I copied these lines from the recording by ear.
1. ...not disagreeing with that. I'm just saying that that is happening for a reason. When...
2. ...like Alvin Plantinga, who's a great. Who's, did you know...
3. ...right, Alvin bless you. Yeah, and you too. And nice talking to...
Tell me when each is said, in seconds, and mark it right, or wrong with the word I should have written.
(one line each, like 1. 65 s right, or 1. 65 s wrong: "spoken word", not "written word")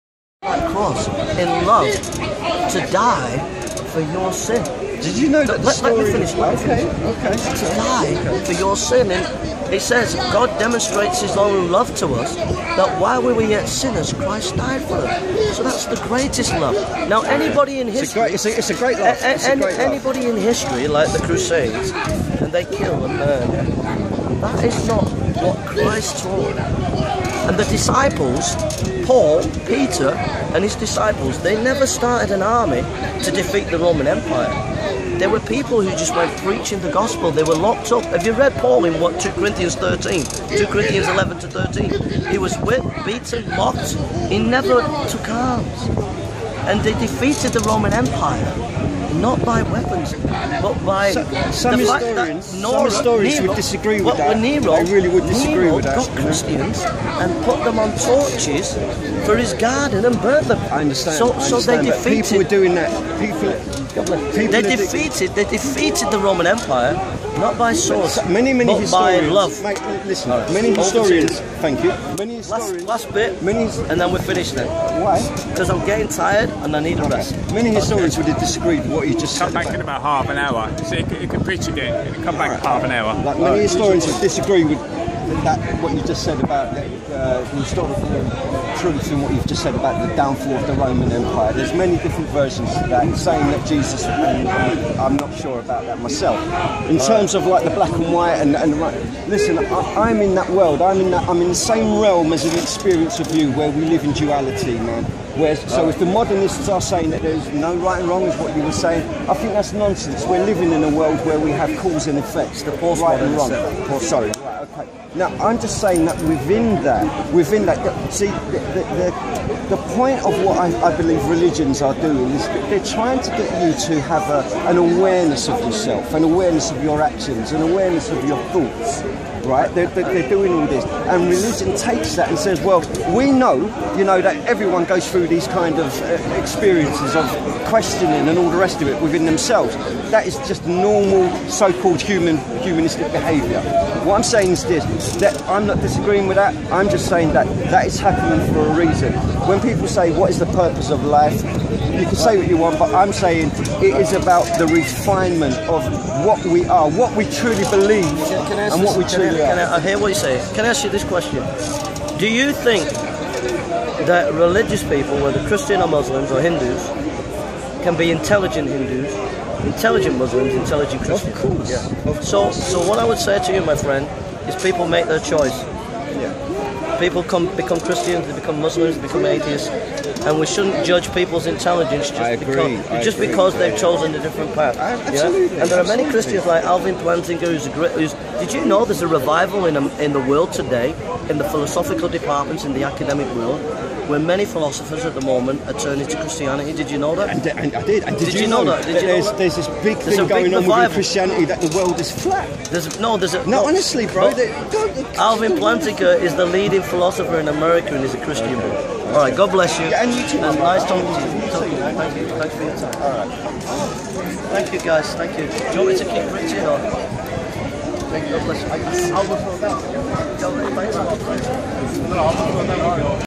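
1. 145 s right
2. 186 s right
3. 209 s wrong: "God", not "Alvin".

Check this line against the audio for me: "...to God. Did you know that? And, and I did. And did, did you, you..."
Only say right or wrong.
wrong.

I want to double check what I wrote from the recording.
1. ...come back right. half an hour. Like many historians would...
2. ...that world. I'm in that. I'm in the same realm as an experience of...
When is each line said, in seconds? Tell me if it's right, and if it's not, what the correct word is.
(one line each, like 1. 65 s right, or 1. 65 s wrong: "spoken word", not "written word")
1. 82 s right
2. 100 s right.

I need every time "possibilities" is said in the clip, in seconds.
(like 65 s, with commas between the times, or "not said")
not said.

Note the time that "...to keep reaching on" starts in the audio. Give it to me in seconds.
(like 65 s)
215 s.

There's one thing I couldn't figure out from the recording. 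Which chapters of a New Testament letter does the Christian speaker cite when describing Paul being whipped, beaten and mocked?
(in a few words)
2 Corinthians 11 to 13.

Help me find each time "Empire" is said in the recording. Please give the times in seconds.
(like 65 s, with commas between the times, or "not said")
34 s, 47 s, 66 s, 91 s.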